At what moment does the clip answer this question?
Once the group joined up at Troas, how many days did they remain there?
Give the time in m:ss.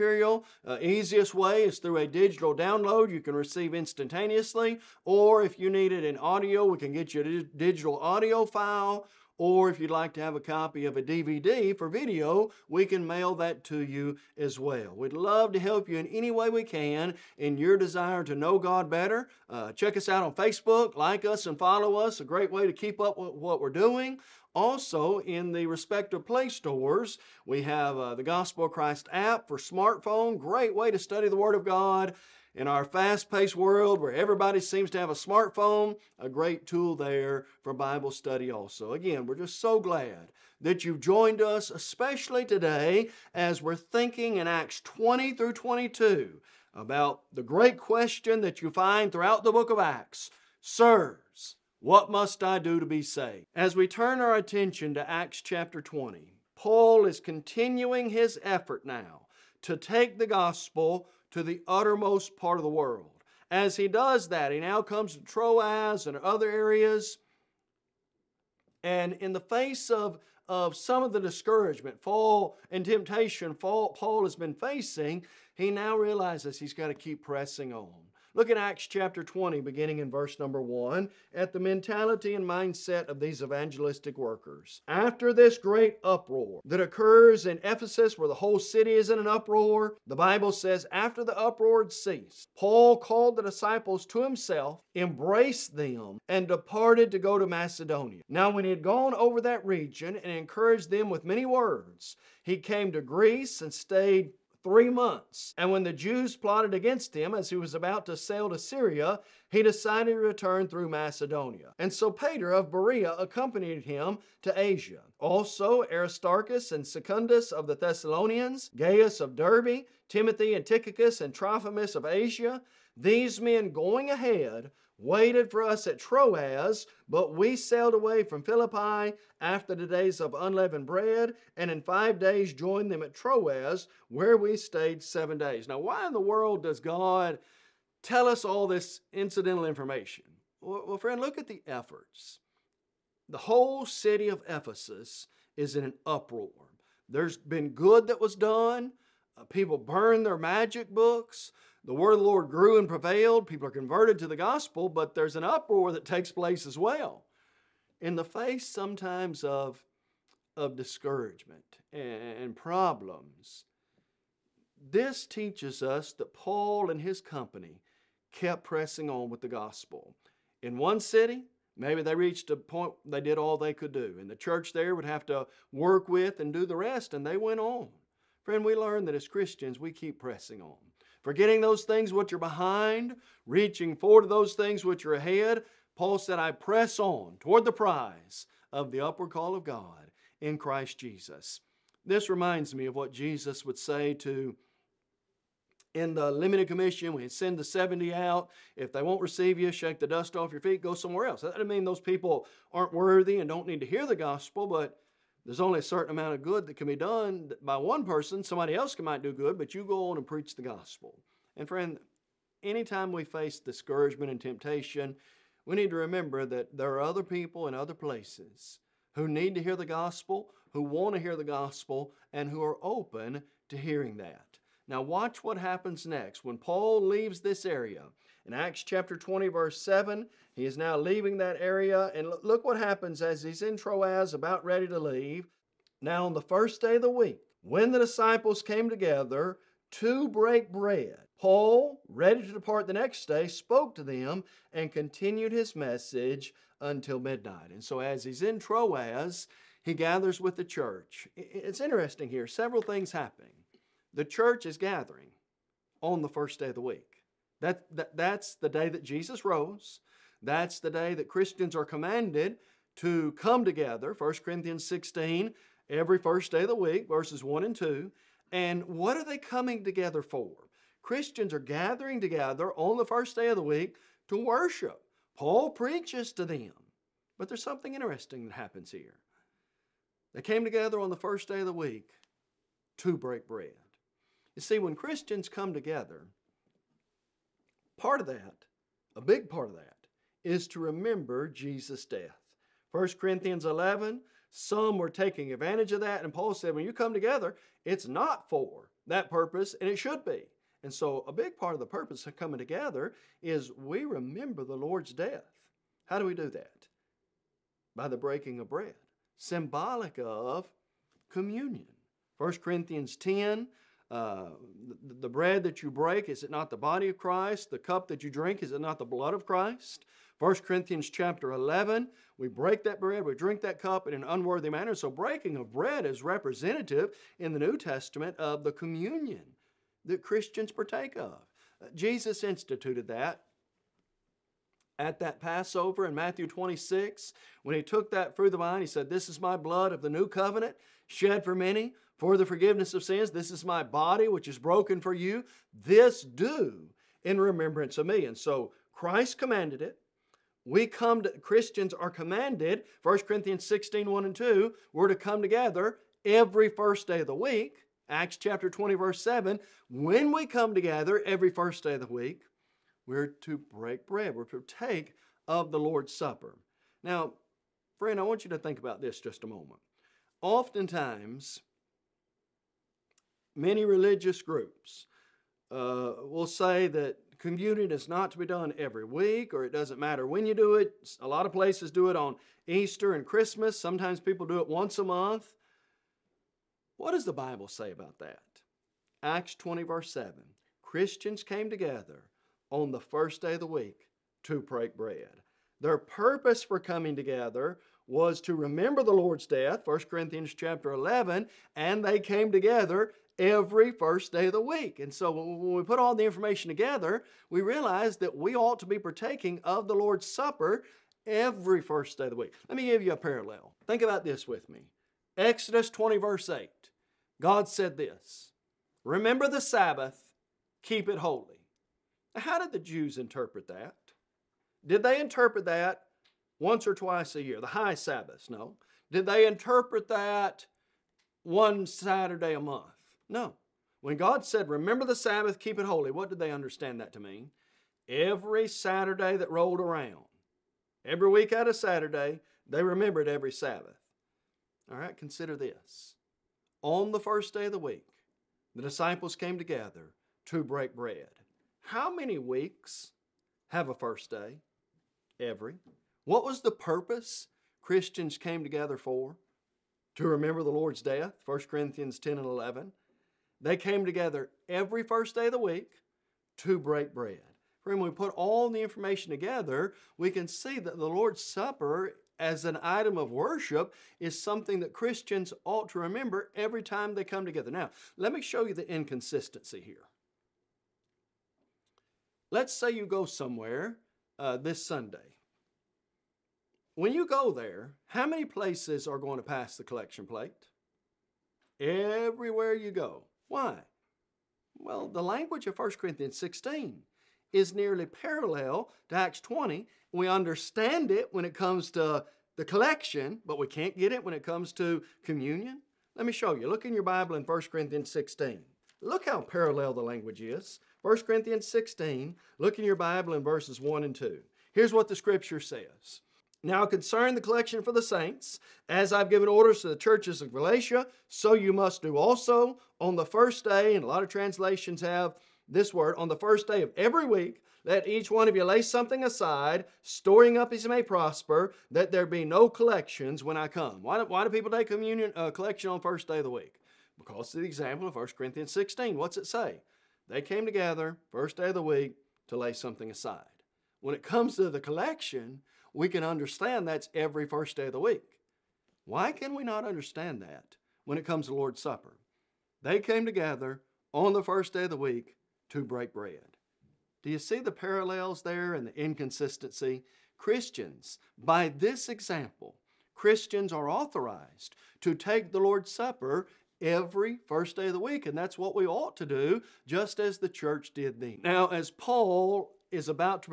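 2:15.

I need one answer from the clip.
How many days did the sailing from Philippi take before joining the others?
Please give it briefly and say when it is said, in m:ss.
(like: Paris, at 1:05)
5, at 2:11.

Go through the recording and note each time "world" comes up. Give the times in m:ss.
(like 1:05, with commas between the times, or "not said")
0:33, 1:02, 2:16.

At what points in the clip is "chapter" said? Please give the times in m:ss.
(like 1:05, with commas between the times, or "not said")
0:55, 1:18, 3:48, 5:21, 5:58, 6:40.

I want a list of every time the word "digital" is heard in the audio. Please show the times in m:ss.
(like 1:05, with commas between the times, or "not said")
0:02, 0:07.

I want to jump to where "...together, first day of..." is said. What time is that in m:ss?
9:00.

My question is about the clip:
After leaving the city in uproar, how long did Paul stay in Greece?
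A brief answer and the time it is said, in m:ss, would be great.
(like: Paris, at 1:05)
3 months, at 1:44.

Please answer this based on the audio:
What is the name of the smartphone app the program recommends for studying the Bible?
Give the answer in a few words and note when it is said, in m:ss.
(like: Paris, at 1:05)
Gospel of Christ, at 0:28.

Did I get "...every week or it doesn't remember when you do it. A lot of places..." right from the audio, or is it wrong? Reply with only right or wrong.
wrong.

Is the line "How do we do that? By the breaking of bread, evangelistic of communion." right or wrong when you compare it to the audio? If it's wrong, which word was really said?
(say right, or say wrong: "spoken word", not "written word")
wrong: "symbolic", not "evangelistic".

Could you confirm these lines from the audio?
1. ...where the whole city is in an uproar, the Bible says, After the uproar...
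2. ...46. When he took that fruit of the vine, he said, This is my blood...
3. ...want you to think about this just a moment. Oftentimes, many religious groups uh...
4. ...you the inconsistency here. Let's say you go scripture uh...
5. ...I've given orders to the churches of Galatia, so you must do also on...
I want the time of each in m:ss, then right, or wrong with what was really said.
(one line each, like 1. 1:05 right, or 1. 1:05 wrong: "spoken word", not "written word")
1. 1:28 right
2. 5:36 wrong: "26", not "46"
3. 6:08 right
4. 7:58 wrong: "somewhere", not "scripture"
5. 8:39 right.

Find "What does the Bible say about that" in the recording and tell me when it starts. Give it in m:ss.
6:26.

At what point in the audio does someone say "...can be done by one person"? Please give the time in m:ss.
3:26.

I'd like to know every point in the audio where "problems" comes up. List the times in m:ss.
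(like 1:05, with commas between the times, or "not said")
2:42.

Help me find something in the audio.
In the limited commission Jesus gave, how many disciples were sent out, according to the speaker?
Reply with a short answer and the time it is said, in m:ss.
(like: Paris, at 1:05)
70, at 3:17.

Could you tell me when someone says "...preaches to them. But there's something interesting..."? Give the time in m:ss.
4:35.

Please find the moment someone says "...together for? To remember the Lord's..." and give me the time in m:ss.
7:38.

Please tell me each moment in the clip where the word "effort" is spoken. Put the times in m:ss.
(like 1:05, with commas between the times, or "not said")
0:58, 2:21.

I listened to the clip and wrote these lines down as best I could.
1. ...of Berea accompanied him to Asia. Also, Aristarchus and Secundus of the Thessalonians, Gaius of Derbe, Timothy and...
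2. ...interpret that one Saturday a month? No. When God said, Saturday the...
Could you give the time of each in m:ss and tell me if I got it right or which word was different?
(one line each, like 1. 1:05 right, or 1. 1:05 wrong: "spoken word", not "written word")
1. 1:52 right
2. 7:09 wrong: "Remember", not "Saturday".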